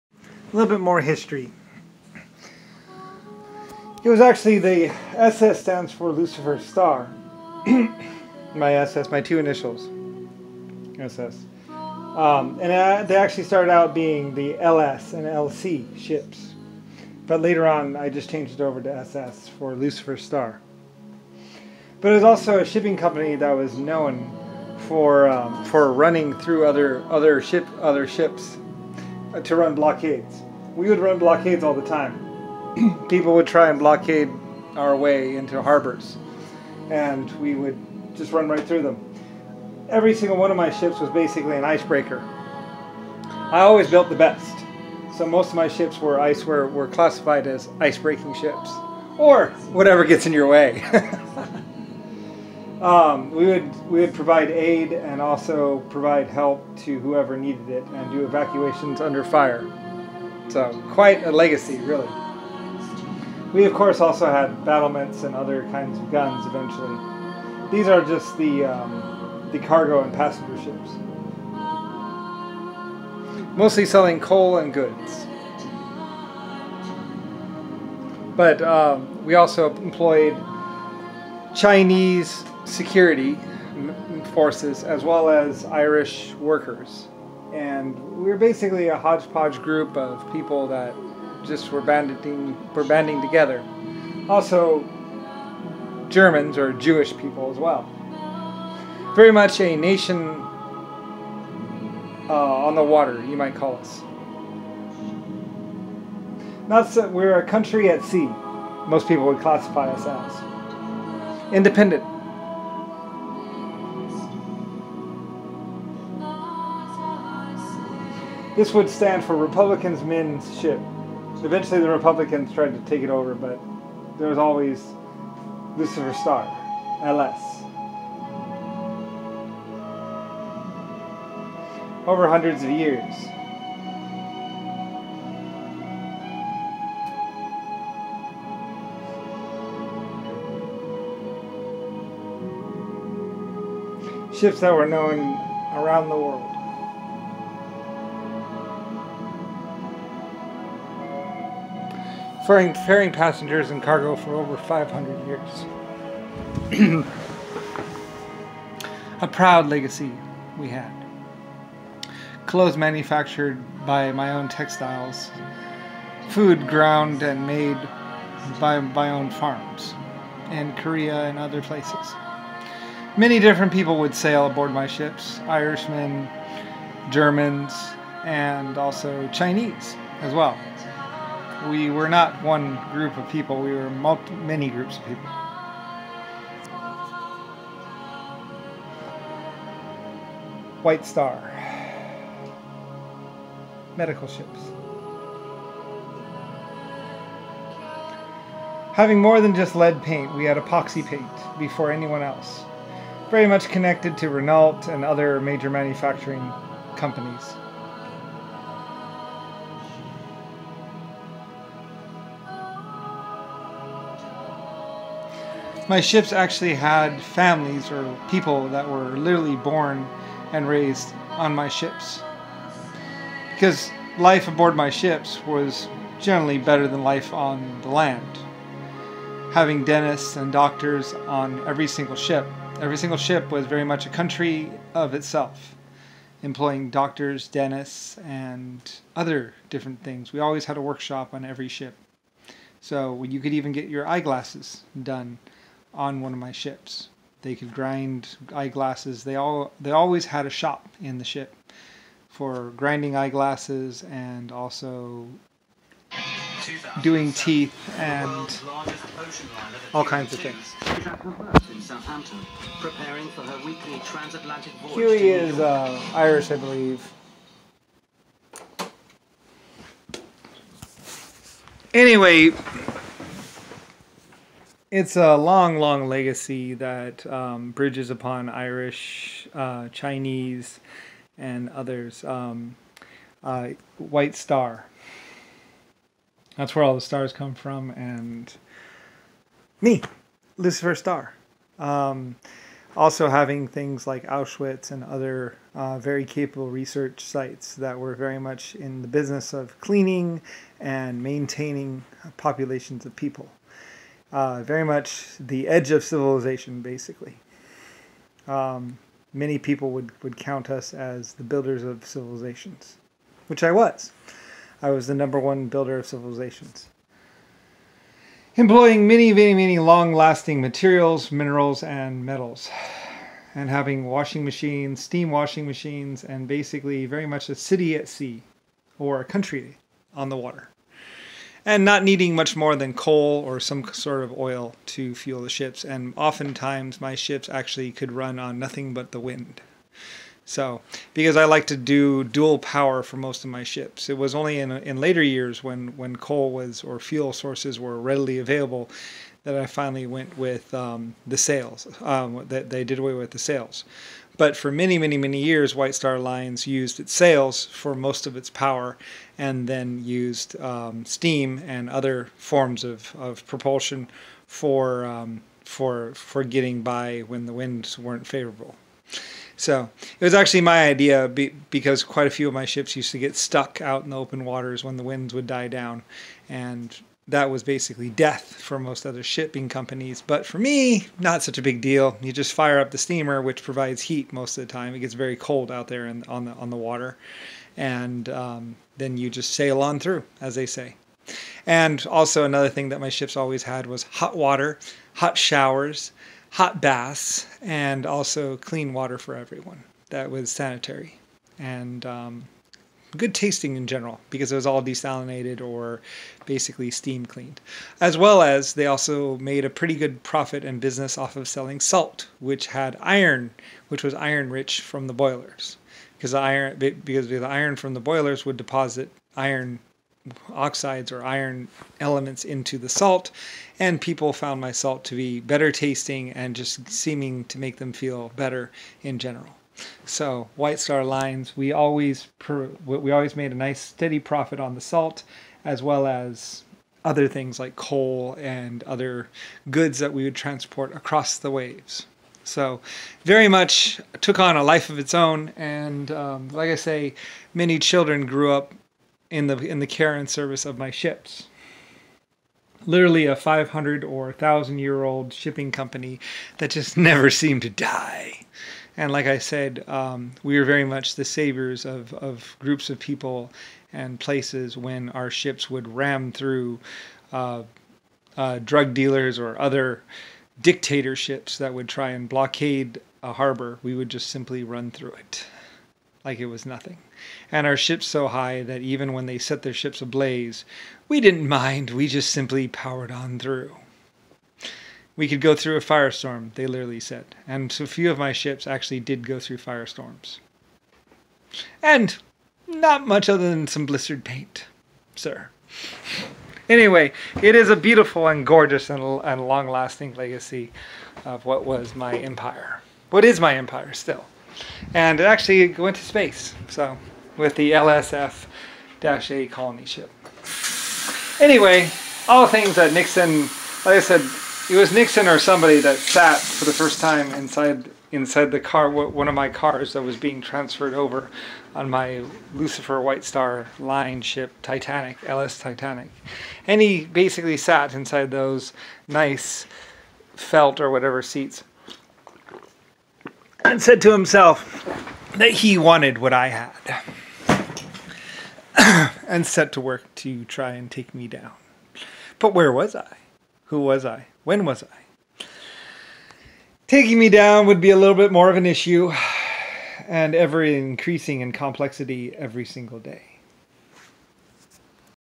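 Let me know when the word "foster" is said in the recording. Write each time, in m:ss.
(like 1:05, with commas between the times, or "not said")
not said.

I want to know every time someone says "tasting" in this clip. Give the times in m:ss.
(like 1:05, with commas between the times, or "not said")
6:43, 7:05.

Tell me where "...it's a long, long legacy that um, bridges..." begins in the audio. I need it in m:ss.
4:34.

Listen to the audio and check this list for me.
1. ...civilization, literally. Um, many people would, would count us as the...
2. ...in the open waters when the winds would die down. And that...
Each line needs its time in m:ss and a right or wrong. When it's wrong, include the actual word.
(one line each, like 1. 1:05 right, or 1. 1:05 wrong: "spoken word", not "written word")
1. 5:06 wrong: "basically", not "literally"
2. 6:14 right.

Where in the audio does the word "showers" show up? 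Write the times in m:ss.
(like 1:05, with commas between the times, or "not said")
6:35.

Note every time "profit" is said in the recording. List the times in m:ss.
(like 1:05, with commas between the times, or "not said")
6:50, 7:14.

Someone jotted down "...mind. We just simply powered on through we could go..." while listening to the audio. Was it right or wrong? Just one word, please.
right.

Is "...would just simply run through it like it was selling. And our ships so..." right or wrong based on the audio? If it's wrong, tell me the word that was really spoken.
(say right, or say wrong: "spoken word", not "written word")
wrong: "nothing", not "selling".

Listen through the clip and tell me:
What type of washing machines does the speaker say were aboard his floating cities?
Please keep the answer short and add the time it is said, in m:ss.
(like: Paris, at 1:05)
Steam washing machines, at 5:25.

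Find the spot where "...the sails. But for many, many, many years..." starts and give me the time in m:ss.
5:53.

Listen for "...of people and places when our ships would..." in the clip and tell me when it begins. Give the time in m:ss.
7:42.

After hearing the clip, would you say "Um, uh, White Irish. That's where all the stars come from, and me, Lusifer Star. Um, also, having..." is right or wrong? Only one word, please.
wrong.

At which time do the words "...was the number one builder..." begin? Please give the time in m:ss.
5:14.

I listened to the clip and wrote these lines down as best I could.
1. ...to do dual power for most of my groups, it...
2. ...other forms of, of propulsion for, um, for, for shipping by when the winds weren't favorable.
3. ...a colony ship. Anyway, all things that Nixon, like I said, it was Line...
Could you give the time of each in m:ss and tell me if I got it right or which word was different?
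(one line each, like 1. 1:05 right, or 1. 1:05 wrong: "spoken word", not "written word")
1. 5:41 wrong: "ships", not "groups"
2. 6:01 wrong: "getting", not "shipping"
3. 8:29 wrong: "Nixon", not "Line".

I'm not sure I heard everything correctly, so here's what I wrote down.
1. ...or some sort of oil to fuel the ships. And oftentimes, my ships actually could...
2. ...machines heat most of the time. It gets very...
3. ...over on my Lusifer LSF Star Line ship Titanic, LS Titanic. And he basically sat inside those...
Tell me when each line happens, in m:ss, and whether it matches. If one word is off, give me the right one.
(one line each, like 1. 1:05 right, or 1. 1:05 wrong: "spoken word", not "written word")
1. 5:33 right
2. 6:23 wrong: "provides", not "machines"
3. 8:40 wrong: "White", not "LSF".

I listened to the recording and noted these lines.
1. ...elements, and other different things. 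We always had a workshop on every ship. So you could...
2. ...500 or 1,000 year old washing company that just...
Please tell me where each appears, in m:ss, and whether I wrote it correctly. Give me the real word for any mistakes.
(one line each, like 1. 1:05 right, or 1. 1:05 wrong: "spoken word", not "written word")
1. 3:57 wrong: "dentists", not "elements"
2. 7:33 wrong: "shipping", not "washing".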